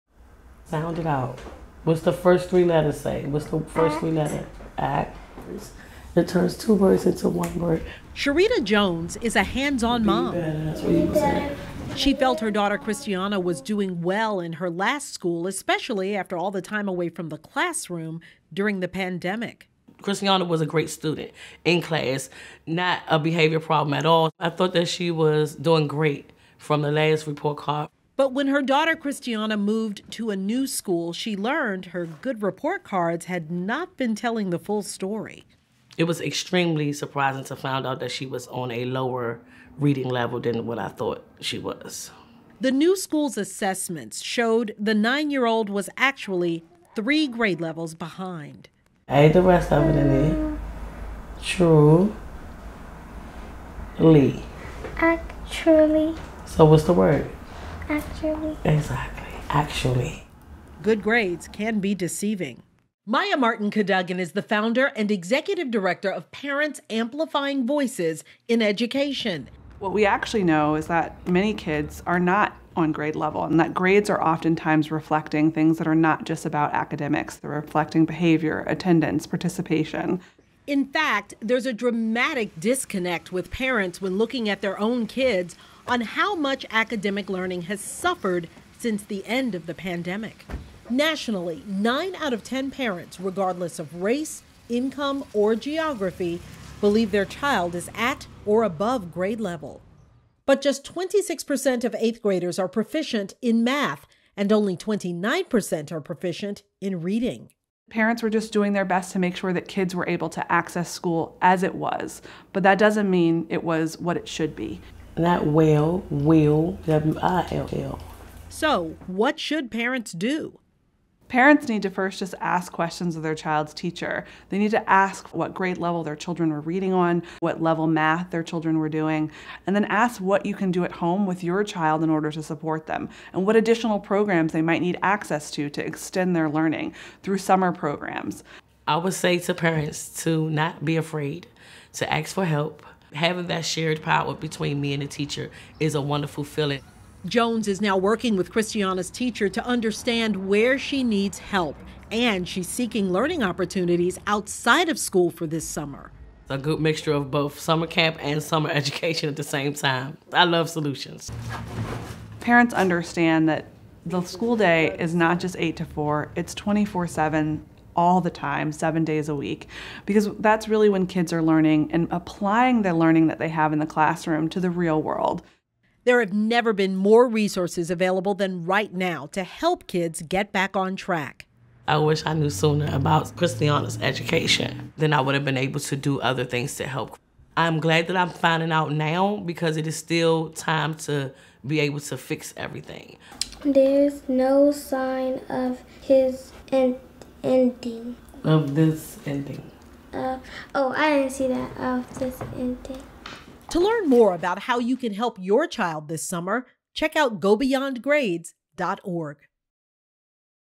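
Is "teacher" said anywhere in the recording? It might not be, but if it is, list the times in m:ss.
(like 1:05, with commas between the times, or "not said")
2:03, 2:25, 2:29.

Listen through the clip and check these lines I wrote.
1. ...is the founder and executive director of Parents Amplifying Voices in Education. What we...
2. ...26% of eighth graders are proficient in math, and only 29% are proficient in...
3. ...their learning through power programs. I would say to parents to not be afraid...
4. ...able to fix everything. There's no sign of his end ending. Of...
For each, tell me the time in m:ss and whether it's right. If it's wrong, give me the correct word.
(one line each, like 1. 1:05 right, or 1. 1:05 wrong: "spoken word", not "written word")
1. 1:04 right
2. 1:40 right
3. 2:16 wrong: "summer", not "power"
4. 3:11 right.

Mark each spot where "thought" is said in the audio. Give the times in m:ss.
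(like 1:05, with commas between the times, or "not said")
0:24, 0:40.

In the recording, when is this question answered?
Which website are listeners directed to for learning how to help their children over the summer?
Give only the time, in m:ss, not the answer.
3:27.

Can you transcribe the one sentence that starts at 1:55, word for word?
Not well, will, W I L L.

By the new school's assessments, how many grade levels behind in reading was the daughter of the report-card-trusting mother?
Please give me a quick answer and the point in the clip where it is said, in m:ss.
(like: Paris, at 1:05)
3, at 0:46.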